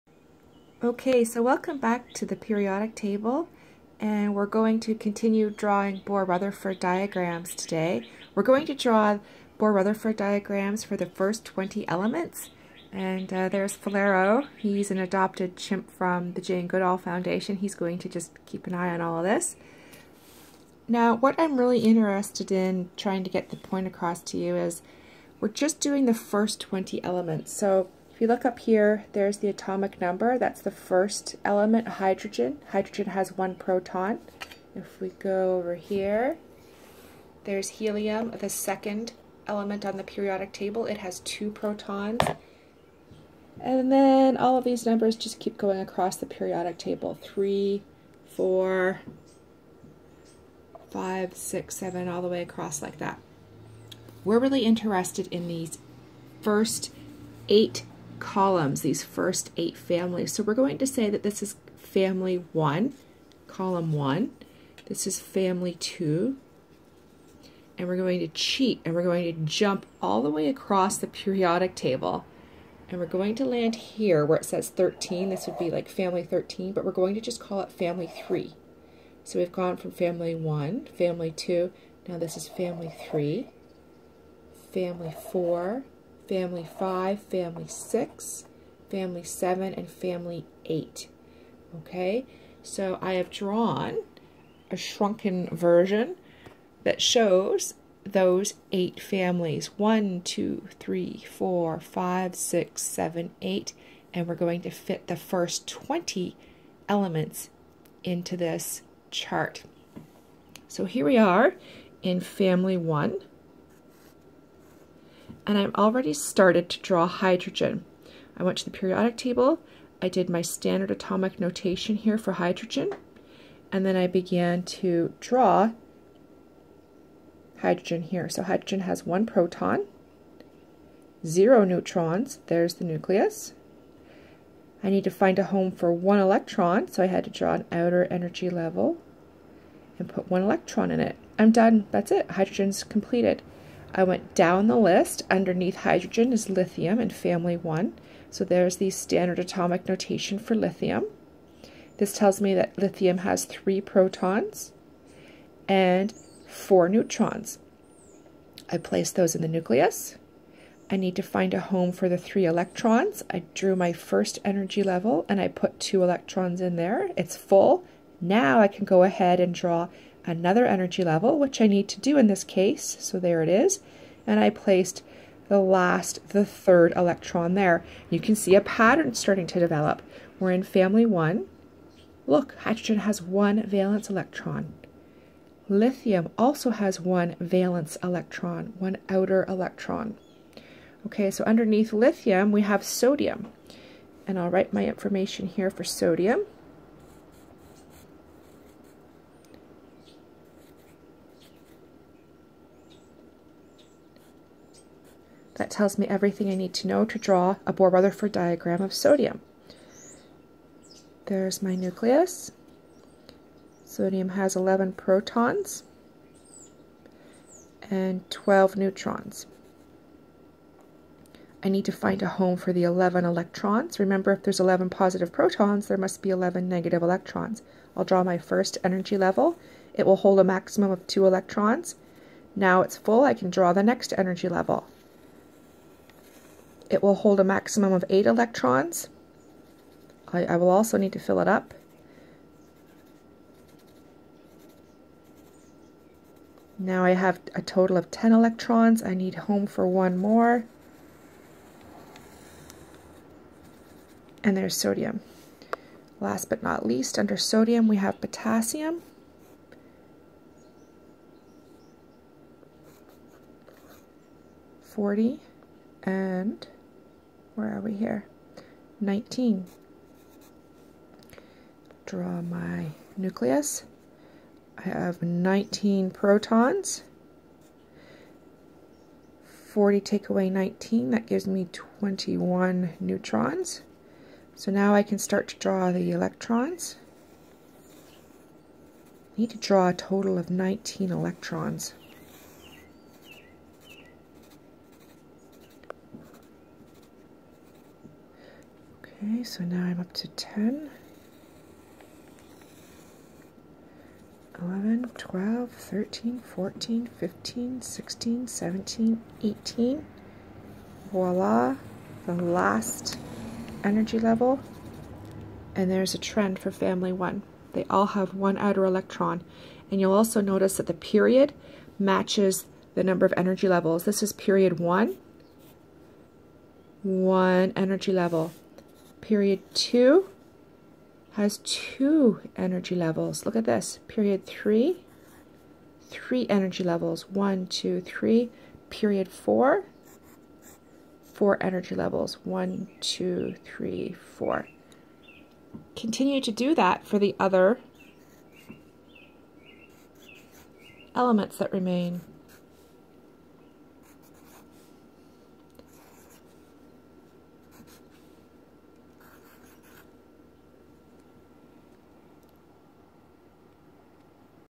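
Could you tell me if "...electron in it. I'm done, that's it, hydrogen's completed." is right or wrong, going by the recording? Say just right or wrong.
right.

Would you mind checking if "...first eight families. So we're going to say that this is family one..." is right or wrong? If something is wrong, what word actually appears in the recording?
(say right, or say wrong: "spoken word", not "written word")
right.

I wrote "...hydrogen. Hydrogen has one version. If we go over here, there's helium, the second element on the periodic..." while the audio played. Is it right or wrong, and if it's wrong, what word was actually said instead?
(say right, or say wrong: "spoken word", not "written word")
wrong: "proton", not "version".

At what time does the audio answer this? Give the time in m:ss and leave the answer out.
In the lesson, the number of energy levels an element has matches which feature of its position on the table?
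5:20.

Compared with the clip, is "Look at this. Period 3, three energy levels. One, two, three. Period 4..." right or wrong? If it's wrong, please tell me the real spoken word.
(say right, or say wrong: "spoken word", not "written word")
right.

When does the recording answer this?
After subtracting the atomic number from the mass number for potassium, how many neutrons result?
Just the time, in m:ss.
4:41.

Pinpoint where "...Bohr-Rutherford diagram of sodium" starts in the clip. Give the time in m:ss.
3:27.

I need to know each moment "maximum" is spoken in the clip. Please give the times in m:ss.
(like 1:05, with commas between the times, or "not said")
3:50, 3:57.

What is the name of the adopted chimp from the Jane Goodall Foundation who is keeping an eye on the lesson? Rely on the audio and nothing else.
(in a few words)
Falero.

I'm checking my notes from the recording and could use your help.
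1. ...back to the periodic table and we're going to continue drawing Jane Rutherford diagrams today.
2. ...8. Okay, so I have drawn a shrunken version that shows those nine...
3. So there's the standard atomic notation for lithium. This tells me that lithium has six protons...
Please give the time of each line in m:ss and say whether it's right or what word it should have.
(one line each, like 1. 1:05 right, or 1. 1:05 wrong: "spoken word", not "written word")
1. 0:01 wrong: "Bohr", not "Jane"
2. 1:30 wrong: "eight", not "nine"
3. 2:28 wrong: "three", not "six".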